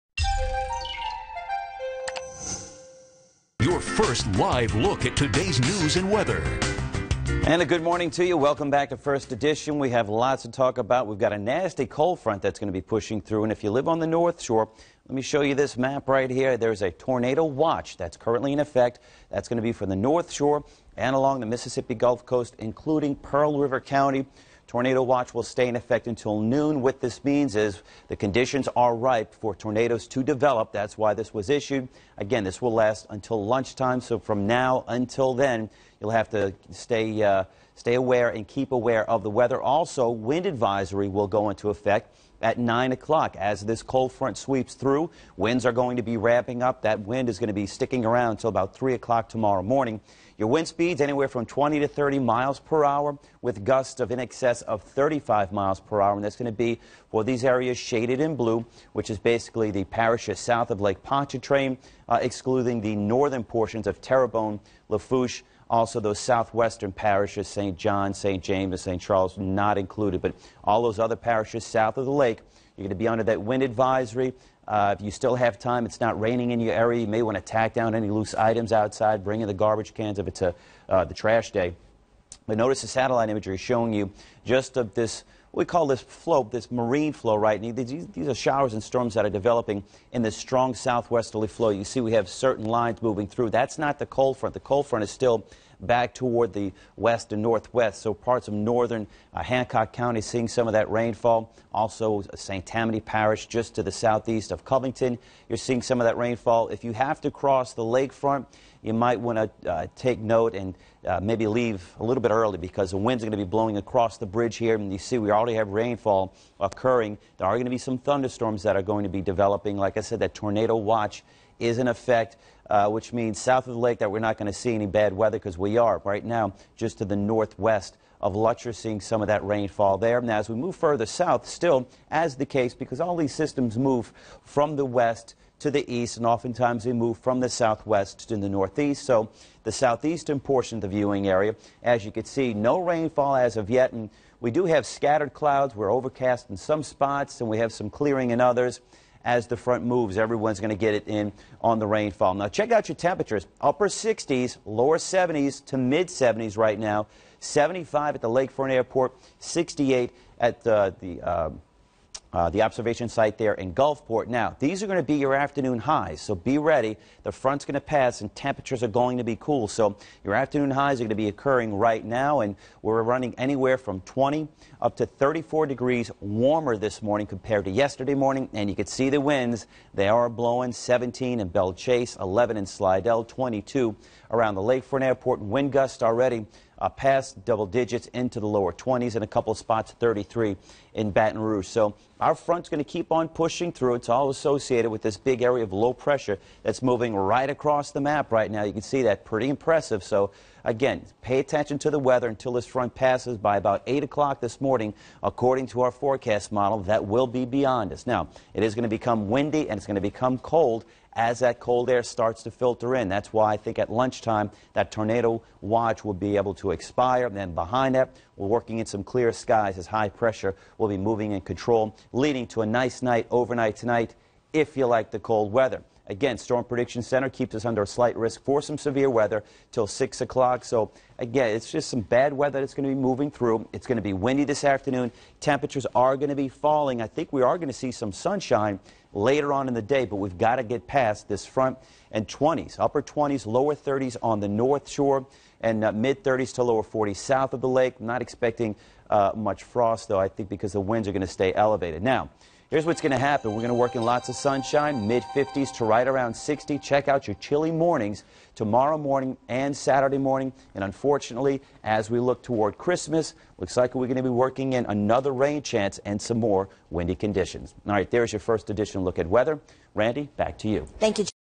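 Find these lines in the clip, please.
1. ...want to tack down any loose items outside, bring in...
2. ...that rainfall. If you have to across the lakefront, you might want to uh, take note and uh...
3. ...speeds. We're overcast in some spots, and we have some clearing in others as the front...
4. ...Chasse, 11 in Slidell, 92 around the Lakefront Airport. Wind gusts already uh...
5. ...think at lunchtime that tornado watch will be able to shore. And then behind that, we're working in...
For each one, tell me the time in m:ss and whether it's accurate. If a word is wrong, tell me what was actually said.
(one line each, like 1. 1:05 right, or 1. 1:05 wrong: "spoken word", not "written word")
1. 1:17 right
2. 1:46 wrong: "cross", not "across"
3. 2:25 wrong: "clouds", not "speeds"
4. 3:01 wrong: "22", not "92"
5. 3:33 wrong: "expire", not "shore".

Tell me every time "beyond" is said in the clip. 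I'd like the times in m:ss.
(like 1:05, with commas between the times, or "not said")
3:27.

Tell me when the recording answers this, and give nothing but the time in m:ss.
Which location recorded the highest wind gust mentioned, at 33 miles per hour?
3:11.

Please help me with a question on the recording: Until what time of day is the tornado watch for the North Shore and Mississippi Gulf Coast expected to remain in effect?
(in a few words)
noon.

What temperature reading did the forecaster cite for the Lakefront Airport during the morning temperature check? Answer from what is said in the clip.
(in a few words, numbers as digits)
75.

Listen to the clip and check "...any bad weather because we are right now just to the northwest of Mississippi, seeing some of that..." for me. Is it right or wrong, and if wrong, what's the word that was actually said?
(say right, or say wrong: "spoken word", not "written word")
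wrong: "Lutcher", not "Mississippi".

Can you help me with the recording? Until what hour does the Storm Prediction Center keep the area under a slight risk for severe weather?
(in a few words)
6 o'clock.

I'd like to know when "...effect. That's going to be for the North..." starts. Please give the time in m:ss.
0:18.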